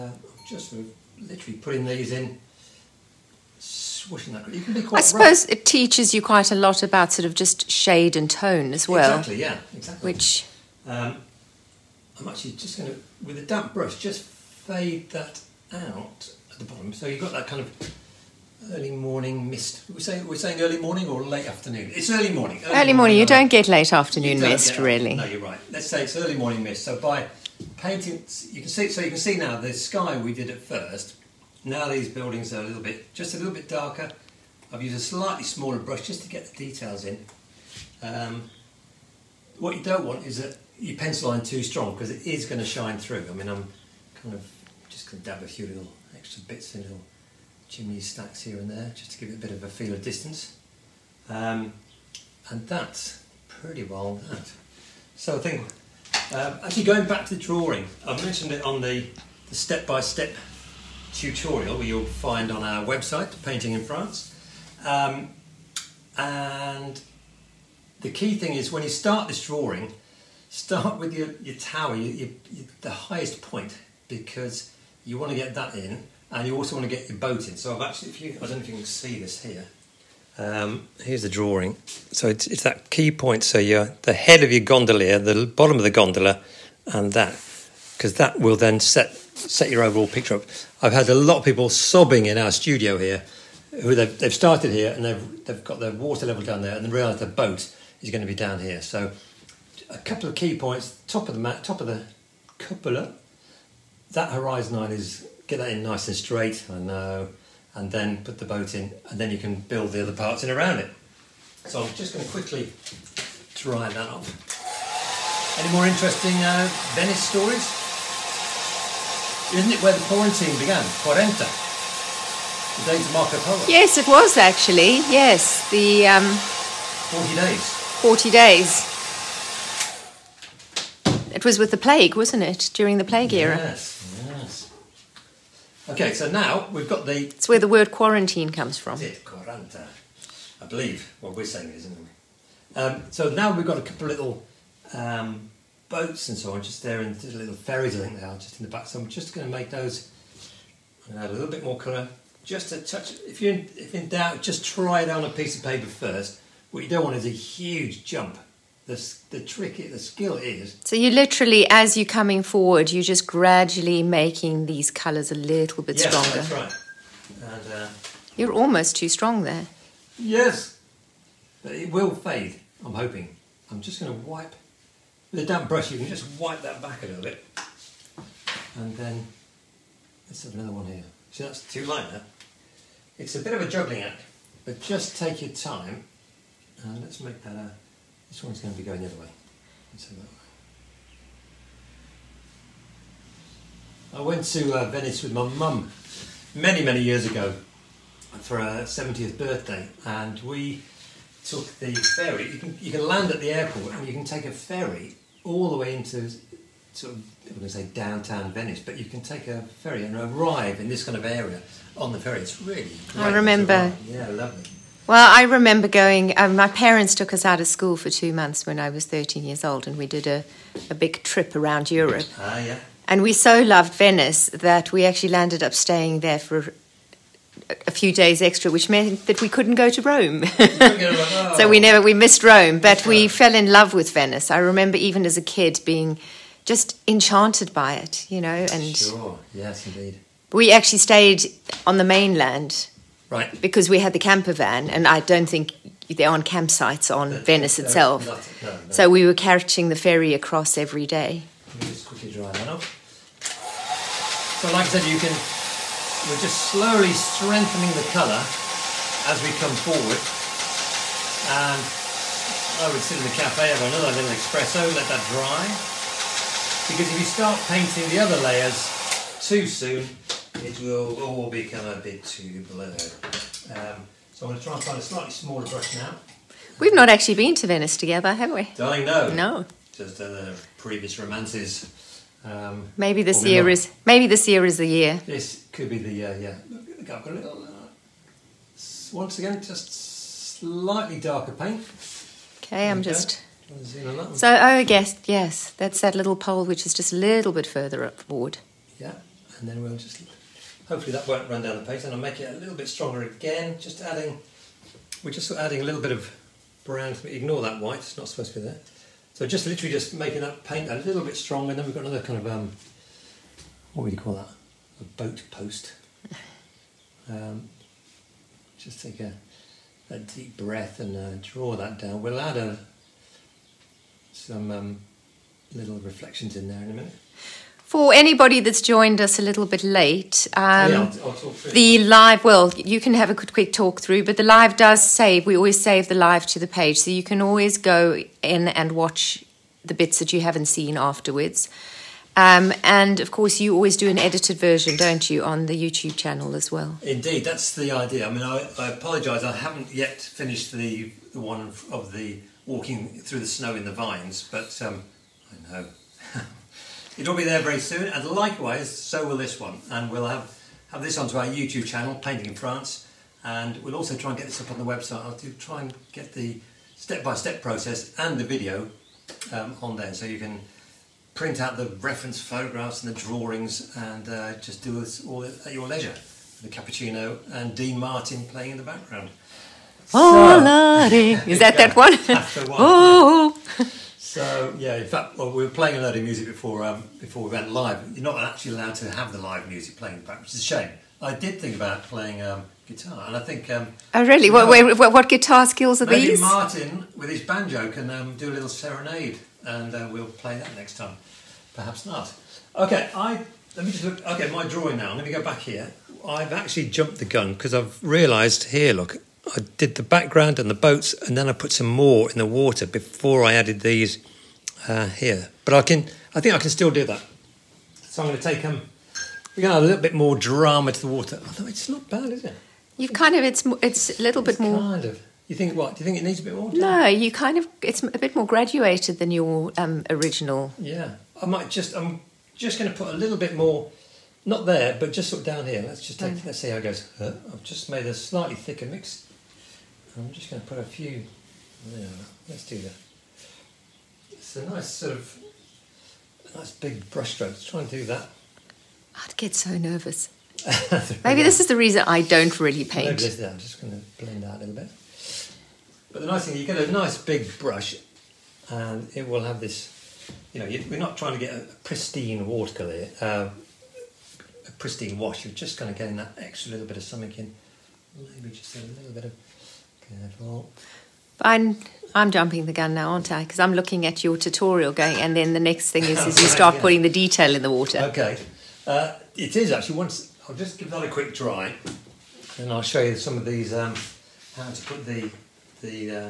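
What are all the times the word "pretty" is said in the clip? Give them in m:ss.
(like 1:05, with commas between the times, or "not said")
0:53.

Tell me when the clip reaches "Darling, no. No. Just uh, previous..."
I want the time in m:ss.
4:38.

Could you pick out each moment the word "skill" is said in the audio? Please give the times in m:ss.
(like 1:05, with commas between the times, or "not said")
2:39, 6:35.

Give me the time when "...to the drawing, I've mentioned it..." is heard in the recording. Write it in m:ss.
0:57.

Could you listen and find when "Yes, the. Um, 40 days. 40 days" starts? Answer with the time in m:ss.
2:05.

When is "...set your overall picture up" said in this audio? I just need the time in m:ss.
1:29.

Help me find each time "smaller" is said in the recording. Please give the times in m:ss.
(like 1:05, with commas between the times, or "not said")
0:35, 4:35.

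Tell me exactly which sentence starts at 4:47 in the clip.
Uh, once again, just slightly darker paint.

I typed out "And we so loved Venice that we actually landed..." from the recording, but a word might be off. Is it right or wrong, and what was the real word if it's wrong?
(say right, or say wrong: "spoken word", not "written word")
right.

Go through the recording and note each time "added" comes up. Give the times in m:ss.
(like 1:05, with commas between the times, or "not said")
6:53.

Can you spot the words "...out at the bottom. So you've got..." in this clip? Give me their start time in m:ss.
0:15.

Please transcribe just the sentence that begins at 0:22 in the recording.
Early, early morning, morning, You don't get late afternoon mist, really.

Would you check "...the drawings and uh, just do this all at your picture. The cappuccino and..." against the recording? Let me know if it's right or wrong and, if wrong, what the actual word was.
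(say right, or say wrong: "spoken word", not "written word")
wrong: "leisure", not "picture".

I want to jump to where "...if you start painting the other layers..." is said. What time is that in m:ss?
4:27.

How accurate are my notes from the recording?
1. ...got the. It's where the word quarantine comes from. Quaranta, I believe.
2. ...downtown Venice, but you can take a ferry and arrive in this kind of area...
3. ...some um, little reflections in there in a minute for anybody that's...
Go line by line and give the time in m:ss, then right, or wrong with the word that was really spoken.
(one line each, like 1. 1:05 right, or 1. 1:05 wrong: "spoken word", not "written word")
1. 2:16 right
2. 3:27 right
3. 5:24 right.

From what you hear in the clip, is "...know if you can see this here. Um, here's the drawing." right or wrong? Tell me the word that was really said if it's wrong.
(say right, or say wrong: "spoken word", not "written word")
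right.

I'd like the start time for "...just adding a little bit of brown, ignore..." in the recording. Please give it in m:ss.
5:05.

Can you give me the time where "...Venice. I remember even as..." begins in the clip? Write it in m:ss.
3:54.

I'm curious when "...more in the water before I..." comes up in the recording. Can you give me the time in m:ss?
6:51.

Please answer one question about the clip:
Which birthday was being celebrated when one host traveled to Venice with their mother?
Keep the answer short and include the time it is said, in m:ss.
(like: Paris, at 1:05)
70th, at 3:18.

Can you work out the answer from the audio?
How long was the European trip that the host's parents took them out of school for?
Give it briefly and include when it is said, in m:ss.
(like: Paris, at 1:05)
Two months, at 3:38.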